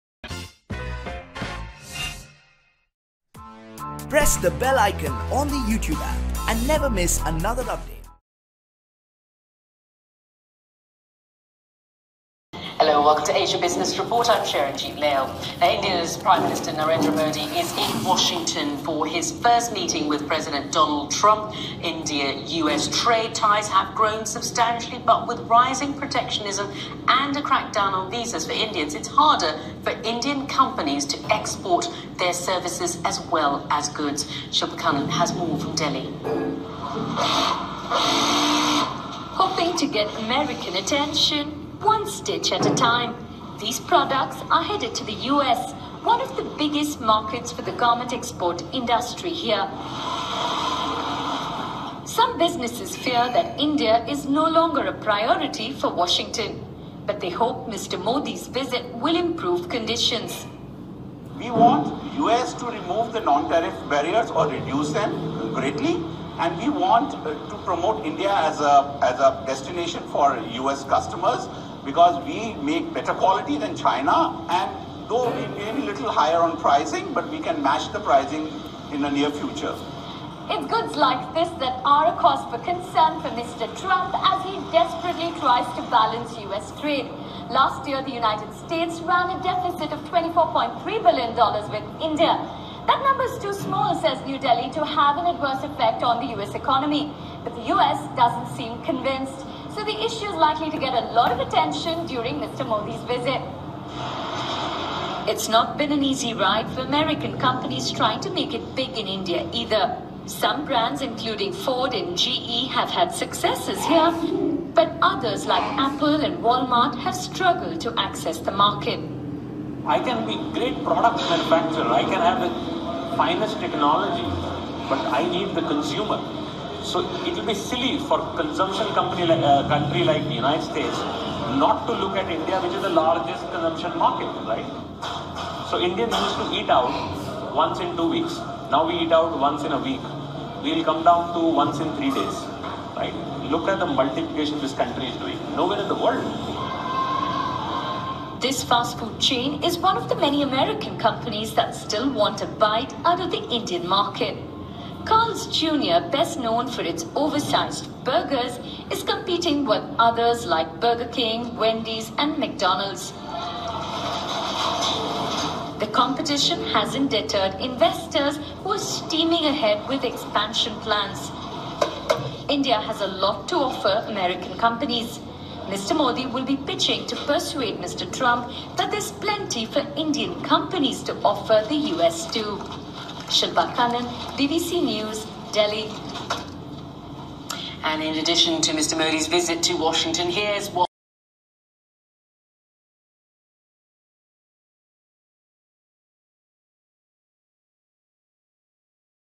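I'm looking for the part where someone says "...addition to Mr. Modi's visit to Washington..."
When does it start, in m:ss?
3:08.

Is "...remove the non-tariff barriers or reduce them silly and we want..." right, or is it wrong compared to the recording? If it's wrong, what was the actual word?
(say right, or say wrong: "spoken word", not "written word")
wrong: "greatly", not "silly".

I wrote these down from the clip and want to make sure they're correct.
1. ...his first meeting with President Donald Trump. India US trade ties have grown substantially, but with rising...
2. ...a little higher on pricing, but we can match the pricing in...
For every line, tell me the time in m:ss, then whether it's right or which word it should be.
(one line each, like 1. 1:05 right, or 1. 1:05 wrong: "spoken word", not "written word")
1. 0:19 right
2. 1:15 right.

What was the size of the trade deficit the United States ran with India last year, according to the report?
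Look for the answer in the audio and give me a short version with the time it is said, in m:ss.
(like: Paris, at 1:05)
$24.3 billion, at 1:30.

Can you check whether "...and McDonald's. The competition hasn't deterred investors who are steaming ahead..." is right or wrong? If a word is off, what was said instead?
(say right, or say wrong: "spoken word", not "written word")
right.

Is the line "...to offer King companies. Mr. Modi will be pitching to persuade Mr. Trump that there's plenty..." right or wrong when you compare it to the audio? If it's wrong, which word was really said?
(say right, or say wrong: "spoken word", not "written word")
wrong: "American", not "King".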